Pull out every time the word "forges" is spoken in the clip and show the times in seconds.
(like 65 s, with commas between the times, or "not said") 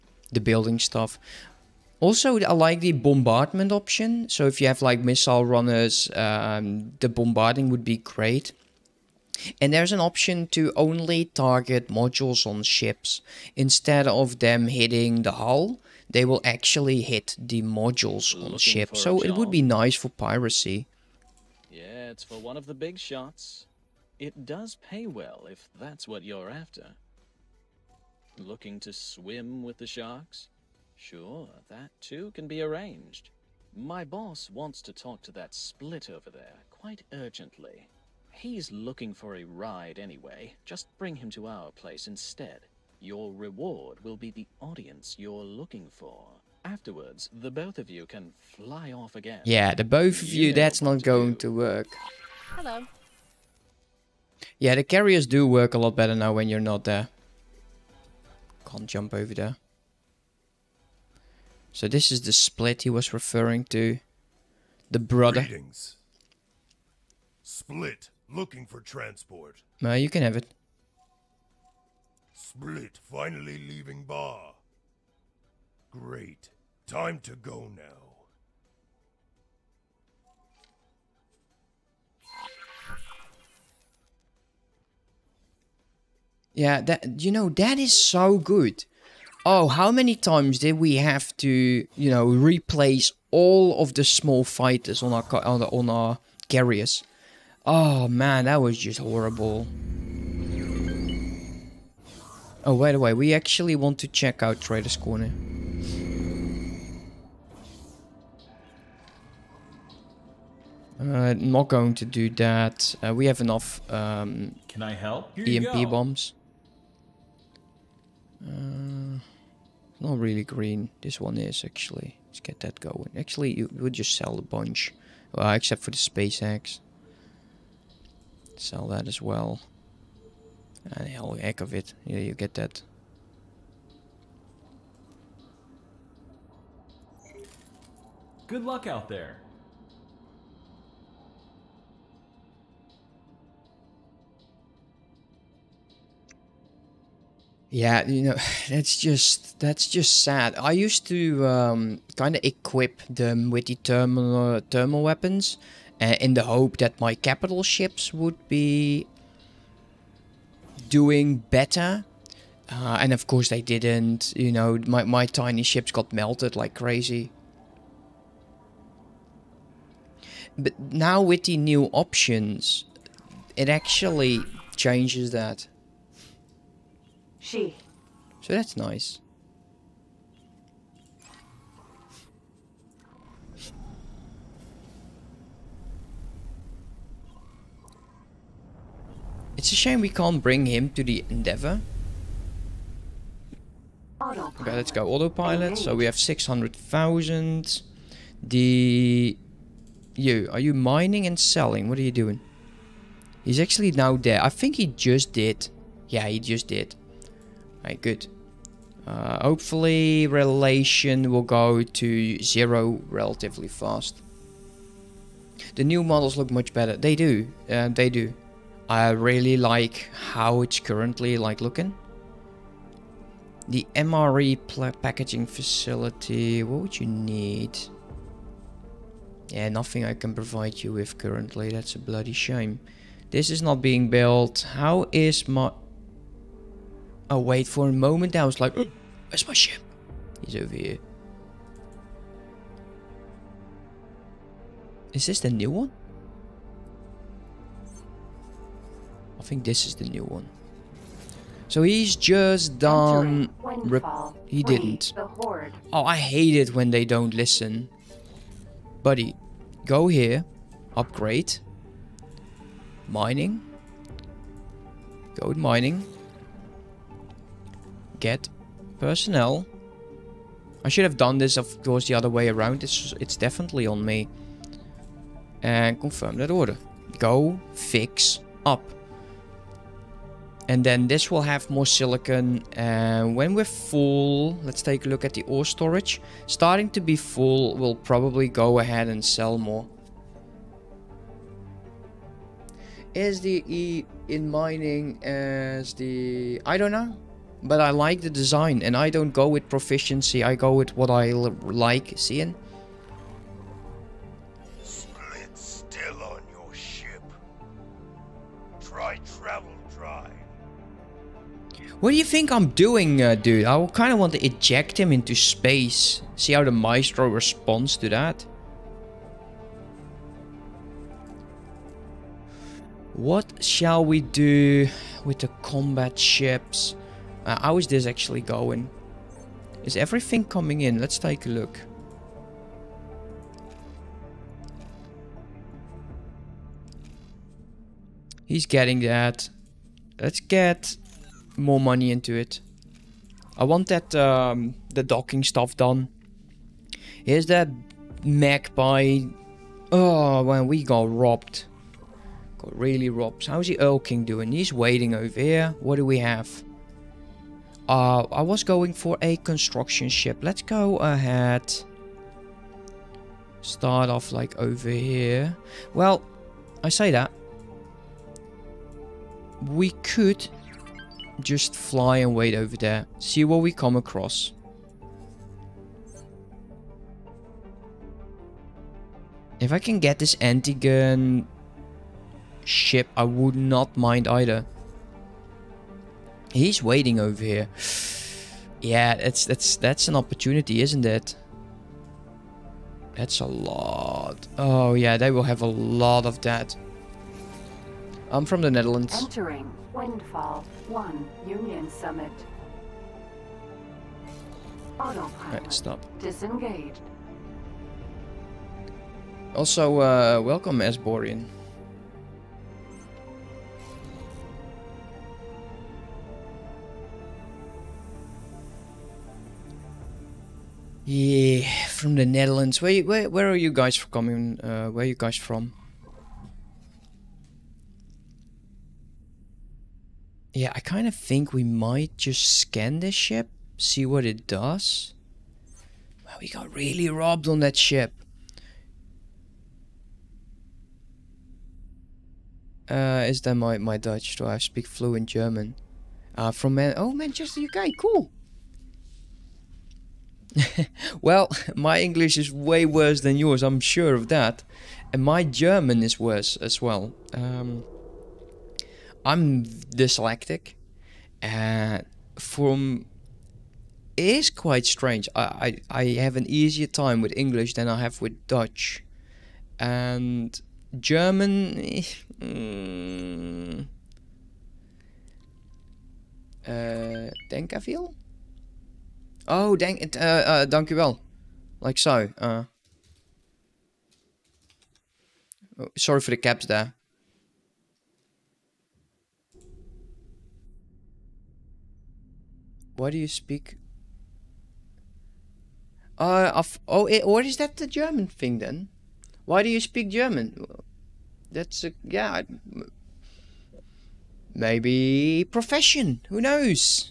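not said.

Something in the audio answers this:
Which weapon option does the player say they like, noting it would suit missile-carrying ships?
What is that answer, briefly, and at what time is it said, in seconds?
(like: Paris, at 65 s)
Bombardment, at 2 s.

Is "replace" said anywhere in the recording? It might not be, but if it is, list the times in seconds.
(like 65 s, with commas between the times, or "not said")
92 s.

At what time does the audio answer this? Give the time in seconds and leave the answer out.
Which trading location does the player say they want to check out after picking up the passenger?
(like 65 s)
104 s.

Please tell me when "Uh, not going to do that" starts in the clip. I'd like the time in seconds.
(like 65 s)
110 s.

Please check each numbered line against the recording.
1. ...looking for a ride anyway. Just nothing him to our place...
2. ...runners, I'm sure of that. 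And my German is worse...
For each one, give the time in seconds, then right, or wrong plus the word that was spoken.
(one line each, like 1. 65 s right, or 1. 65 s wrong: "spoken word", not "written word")
1. 38 s wrong: "bring", not "nothing"
2. 453 s wrong: "yours", not "runners".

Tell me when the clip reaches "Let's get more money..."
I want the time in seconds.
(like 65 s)
340 s.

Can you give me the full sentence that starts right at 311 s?
What do you think I'm doing, uh, dude?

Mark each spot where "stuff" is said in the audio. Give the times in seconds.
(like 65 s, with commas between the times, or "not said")
0 s, 345 s.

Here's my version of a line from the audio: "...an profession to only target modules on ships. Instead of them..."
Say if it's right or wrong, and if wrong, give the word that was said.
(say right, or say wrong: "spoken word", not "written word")
wrong: "option", not "profession".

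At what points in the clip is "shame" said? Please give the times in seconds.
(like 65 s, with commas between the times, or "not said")
189 s, 232 s.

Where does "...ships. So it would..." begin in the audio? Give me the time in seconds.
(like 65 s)
18 s.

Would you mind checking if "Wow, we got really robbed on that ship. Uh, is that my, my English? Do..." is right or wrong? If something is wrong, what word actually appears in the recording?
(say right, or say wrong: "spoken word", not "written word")
wrong: "Dutch", not "English".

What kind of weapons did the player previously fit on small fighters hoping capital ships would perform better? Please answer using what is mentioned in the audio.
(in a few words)
Thermal weapons.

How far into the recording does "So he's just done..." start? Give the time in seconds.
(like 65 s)
251 s.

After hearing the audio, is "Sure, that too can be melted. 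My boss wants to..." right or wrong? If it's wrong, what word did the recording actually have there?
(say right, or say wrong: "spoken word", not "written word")
wrong: "arranged", not "melted".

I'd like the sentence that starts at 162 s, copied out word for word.
Uh, and of course they didn't.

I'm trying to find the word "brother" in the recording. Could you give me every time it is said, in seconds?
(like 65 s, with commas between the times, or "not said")
64 s.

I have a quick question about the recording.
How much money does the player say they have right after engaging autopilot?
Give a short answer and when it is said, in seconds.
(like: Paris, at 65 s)
600,000, at 196 s.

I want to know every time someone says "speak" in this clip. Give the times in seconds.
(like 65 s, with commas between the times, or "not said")
444 s, 493 s, 499 s.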